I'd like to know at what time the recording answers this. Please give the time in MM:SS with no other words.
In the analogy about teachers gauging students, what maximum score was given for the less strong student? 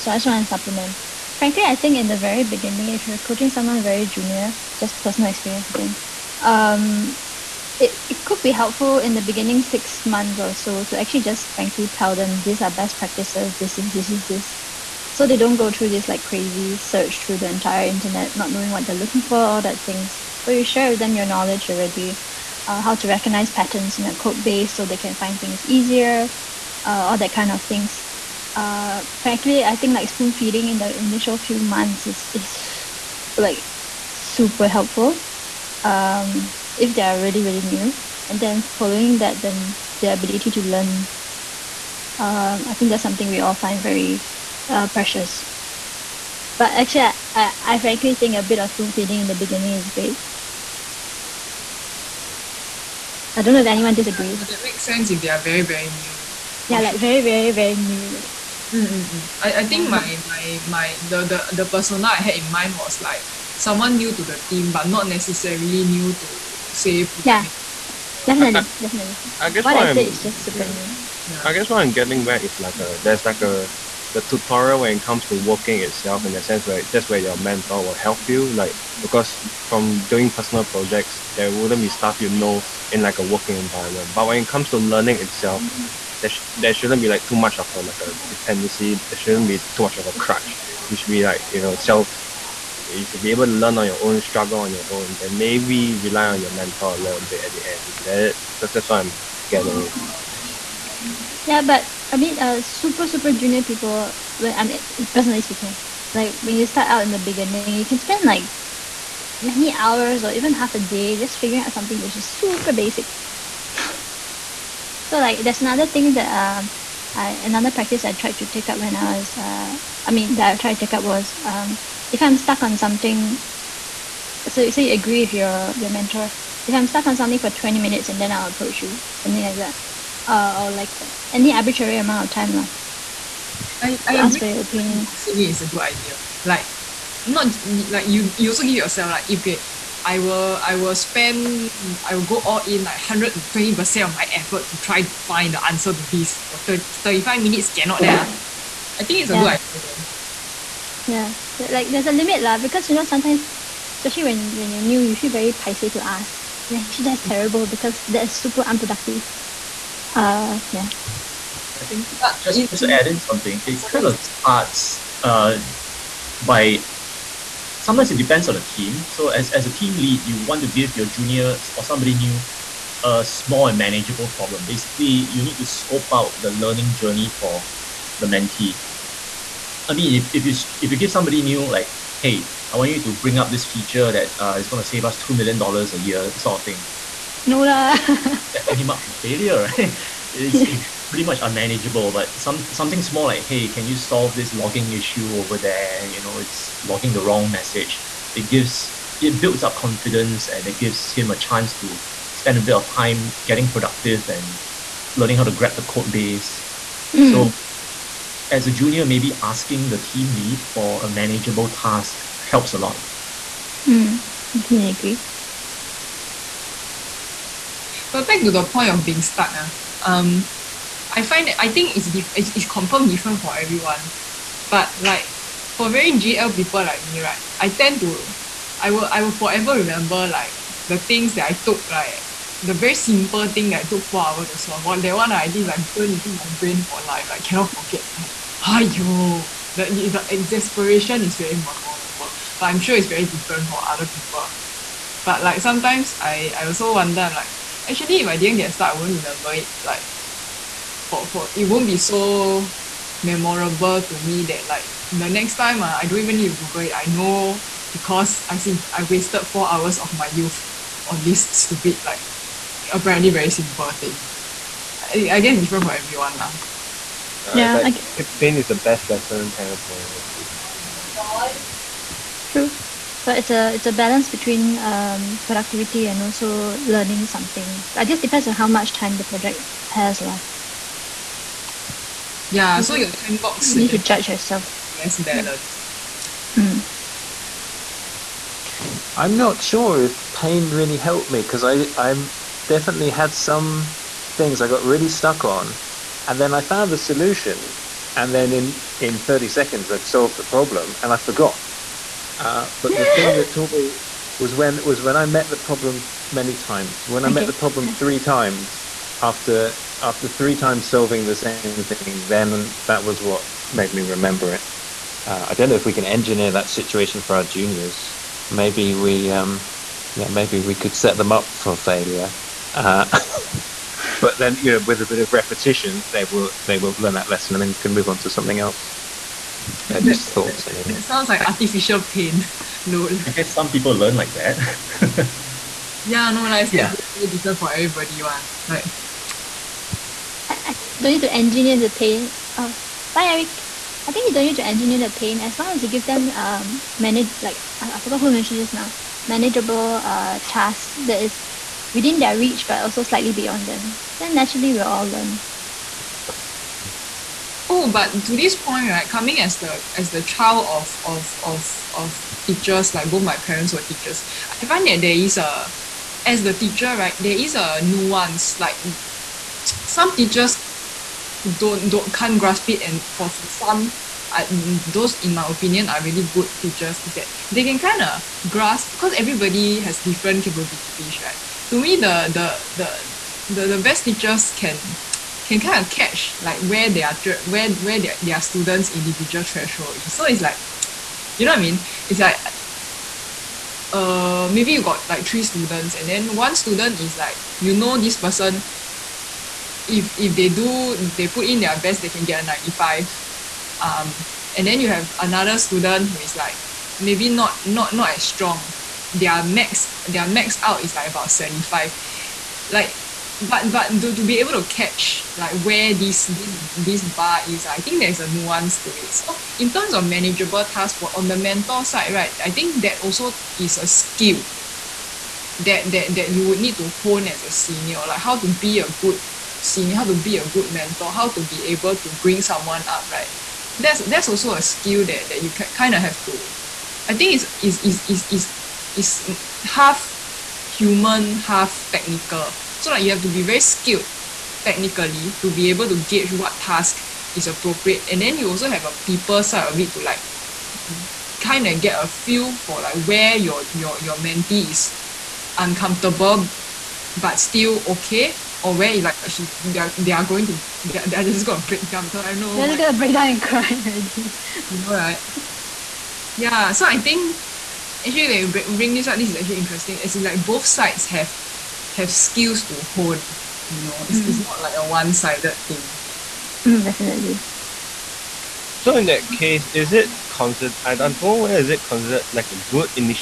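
06:51.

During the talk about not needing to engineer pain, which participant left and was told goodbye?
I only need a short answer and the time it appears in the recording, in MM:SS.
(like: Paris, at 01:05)
Eric, at 05:43.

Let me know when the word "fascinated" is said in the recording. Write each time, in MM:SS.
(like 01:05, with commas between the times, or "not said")
not said.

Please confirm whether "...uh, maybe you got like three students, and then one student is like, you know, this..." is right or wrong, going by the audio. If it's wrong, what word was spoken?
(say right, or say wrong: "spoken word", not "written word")
right.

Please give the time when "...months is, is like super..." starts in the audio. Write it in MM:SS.
00:31.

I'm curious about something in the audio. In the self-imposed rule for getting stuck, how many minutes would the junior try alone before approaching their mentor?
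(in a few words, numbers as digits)
20 minutes.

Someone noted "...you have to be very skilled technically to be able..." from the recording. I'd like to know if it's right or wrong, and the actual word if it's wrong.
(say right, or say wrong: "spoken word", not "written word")
right.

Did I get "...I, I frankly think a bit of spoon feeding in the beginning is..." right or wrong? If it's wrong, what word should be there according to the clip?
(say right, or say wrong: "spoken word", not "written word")
right.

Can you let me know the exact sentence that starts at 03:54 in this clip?
Well, that one I did like burn into my brain for life.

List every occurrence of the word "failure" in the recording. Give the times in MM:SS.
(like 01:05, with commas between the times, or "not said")
03:09, 05:21.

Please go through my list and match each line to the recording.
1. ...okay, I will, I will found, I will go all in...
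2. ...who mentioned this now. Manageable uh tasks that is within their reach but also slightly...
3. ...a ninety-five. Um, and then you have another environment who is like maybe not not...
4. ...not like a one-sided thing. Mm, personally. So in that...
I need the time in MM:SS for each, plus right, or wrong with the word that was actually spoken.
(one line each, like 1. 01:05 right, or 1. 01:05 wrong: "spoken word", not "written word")
1. 02:19 wrong: "spend", not "found"
2. 05:48 right
3. 06:42 wrong: "student", not "environment"
4. 07:54 wrong: "definitely", not "personally".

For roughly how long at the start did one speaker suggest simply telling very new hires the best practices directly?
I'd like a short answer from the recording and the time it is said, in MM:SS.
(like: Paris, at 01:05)
6 months, at 00:09.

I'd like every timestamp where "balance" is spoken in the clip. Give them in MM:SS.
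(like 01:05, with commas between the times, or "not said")
04:33, 04:45.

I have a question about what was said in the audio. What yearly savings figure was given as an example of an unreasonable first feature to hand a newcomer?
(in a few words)
2 million dollars.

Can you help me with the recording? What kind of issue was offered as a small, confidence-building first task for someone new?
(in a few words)
logging issue.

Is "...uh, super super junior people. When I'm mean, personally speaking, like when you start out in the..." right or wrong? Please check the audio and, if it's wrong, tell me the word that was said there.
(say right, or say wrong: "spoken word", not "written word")
right.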